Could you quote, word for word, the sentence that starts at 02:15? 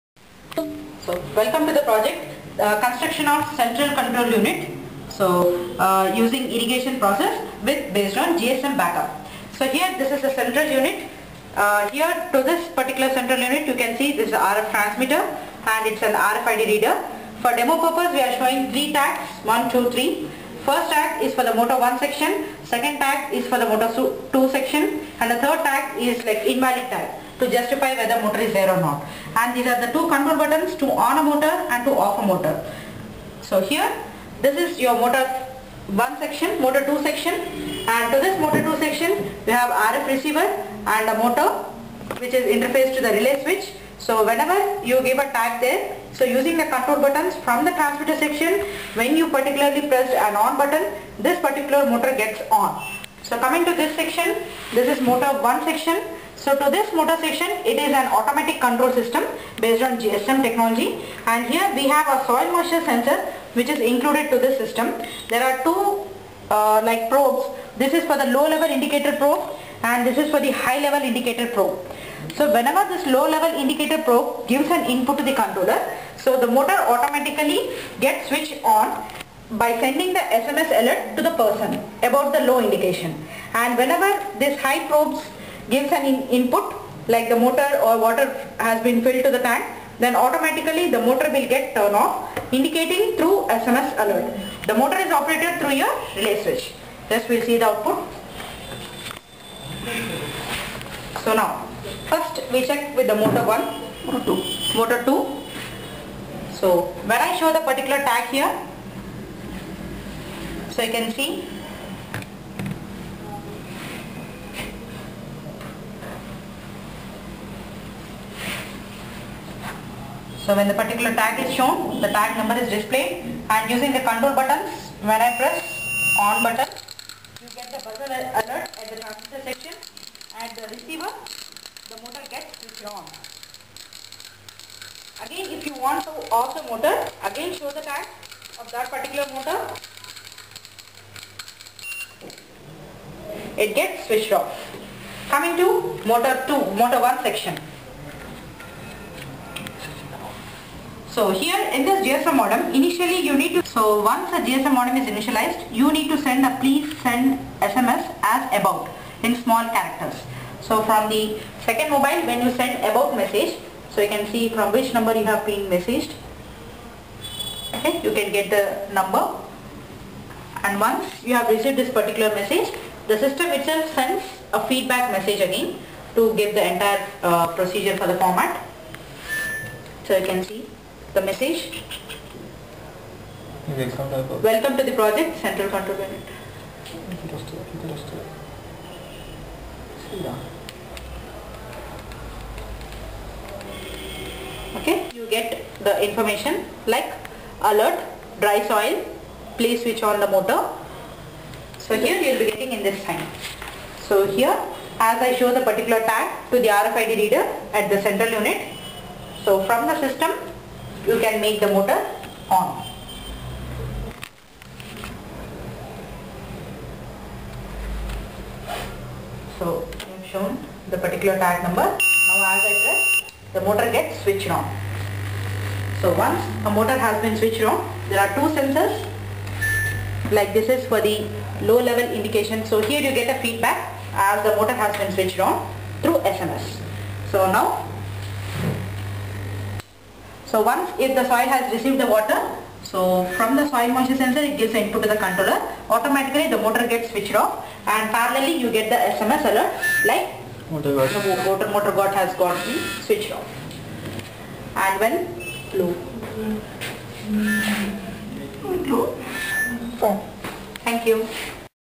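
Again, if you want to off the motor, again show the tag of that particular motor it gets switched off.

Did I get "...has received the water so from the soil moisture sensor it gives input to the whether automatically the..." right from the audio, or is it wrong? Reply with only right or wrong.
wrong.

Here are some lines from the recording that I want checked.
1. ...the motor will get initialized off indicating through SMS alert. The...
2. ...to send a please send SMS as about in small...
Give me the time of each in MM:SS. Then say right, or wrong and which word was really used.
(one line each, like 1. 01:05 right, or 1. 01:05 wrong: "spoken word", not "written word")
1. 01:30 wrong: "turned", not "initialized"
2. 02:36 right.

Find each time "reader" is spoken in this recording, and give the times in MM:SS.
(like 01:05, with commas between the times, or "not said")
00:16, 03:27.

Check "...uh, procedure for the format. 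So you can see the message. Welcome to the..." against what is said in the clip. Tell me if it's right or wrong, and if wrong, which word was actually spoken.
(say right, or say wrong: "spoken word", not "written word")
right.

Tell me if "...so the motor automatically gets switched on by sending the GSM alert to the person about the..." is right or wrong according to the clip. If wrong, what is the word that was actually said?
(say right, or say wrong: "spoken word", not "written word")
wrong: "SMS", not "GSM".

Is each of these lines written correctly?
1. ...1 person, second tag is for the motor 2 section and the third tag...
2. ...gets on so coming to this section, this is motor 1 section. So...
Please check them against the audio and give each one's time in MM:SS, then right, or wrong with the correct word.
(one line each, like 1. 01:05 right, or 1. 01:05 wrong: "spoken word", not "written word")
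1. 00:21 wrong: "section", not "person"
2. 00:52 right.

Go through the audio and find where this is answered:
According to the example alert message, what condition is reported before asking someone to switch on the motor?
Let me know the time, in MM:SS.
03:18.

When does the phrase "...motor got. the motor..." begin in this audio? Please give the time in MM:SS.
04:10.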